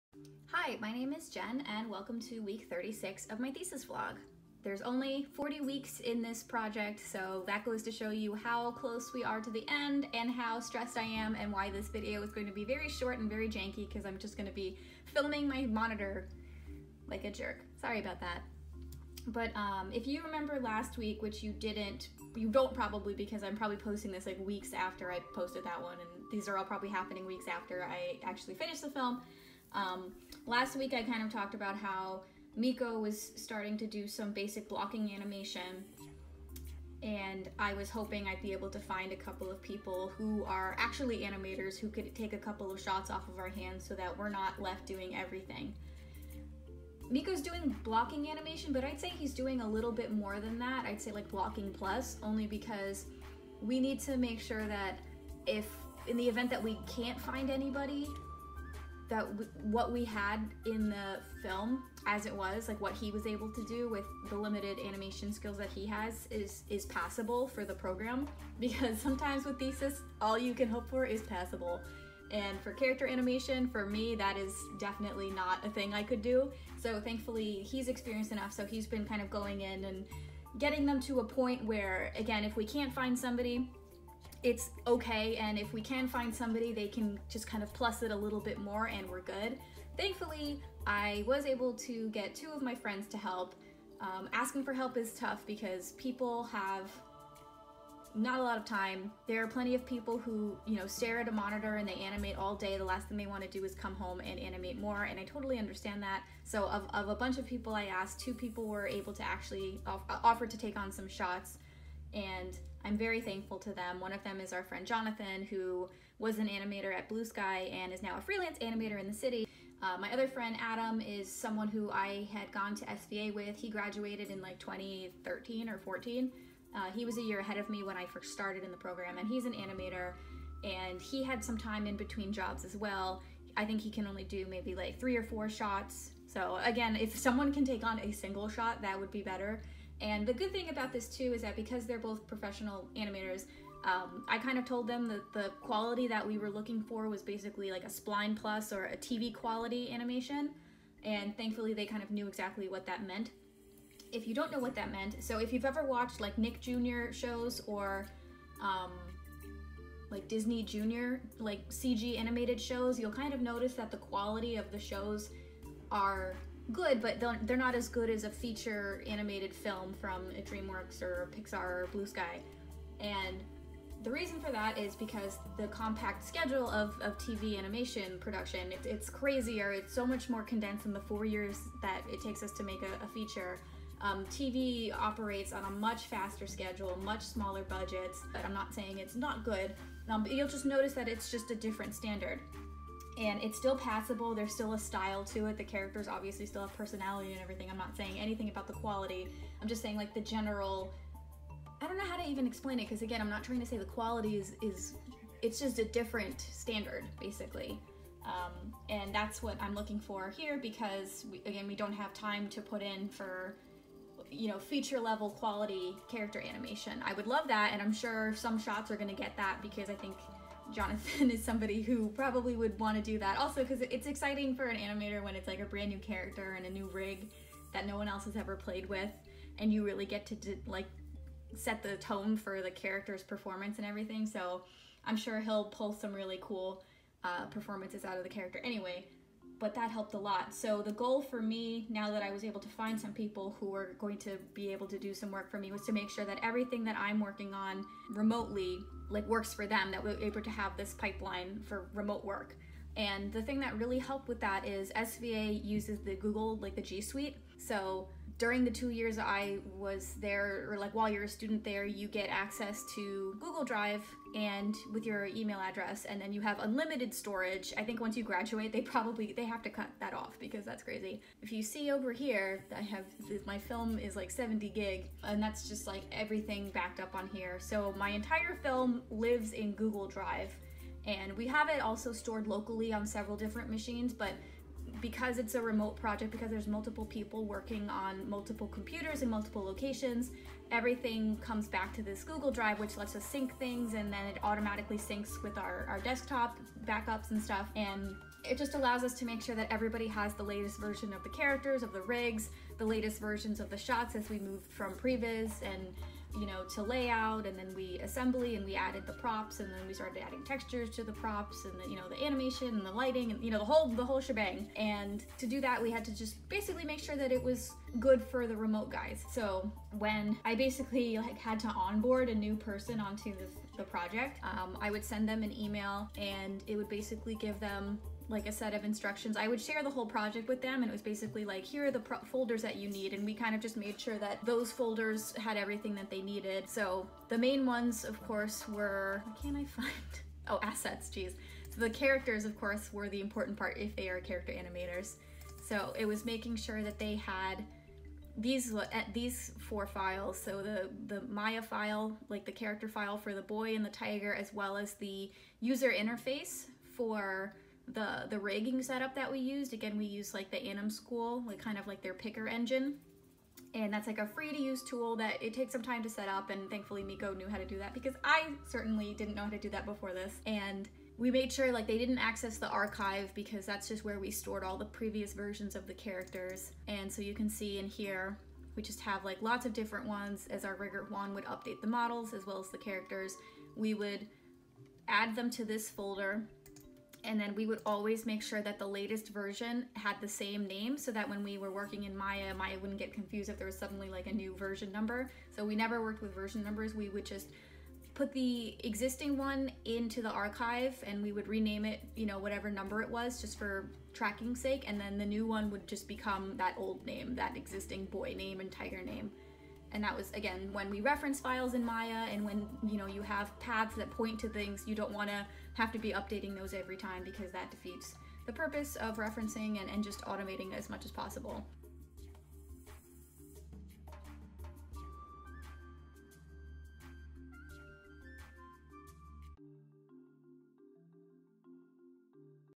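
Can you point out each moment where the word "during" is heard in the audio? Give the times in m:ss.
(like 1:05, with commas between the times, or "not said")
4:18.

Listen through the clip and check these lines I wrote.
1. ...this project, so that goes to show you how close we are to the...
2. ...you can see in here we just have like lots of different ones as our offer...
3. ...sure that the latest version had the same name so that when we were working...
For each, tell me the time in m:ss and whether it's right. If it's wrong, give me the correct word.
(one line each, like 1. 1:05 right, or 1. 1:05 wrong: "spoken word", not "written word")
1. 0:06 right
2. 6:17 wrong: "rigger", not "offer"
3. 6:28 right.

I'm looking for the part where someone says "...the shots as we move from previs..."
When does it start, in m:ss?
5:03.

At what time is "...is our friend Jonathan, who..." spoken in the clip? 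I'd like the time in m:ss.
1:54.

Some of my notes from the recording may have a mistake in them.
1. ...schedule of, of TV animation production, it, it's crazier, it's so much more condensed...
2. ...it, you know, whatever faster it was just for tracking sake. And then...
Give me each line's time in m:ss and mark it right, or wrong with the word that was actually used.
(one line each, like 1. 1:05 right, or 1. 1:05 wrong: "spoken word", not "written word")
1. 2:56 right
2. 6:41 wrong: "number", not "faster".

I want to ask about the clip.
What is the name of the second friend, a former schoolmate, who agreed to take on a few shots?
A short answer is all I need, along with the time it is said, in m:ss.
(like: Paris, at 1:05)
Adam, at 2:00.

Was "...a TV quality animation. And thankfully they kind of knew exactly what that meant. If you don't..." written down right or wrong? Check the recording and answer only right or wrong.
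right.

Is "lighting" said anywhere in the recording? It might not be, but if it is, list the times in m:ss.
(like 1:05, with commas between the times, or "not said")
5:12.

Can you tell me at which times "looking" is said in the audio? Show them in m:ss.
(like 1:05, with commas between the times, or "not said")
2:26, 3:29.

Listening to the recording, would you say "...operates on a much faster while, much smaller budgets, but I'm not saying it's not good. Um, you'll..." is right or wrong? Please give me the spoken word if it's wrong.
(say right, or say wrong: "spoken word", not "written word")
wrong: "schedule", not "while".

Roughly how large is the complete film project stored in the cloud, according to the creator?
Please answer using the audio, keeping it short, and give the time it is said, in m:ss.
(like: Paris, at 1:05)
70 gig, at 4:34.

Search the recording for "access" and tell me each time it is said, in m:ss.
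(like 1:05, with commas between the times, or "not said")
4:22, 6:12.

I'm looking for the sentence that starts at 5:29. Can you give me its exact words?
I would share the whole project with them and it was basically like, here are the folders that you need.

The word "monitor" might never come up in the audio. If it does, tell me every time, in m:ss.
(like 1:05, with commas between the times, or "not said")
0:15, 1:41.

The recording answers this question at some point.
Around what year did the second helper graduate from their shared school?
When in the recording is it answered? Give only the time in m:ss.
2:04.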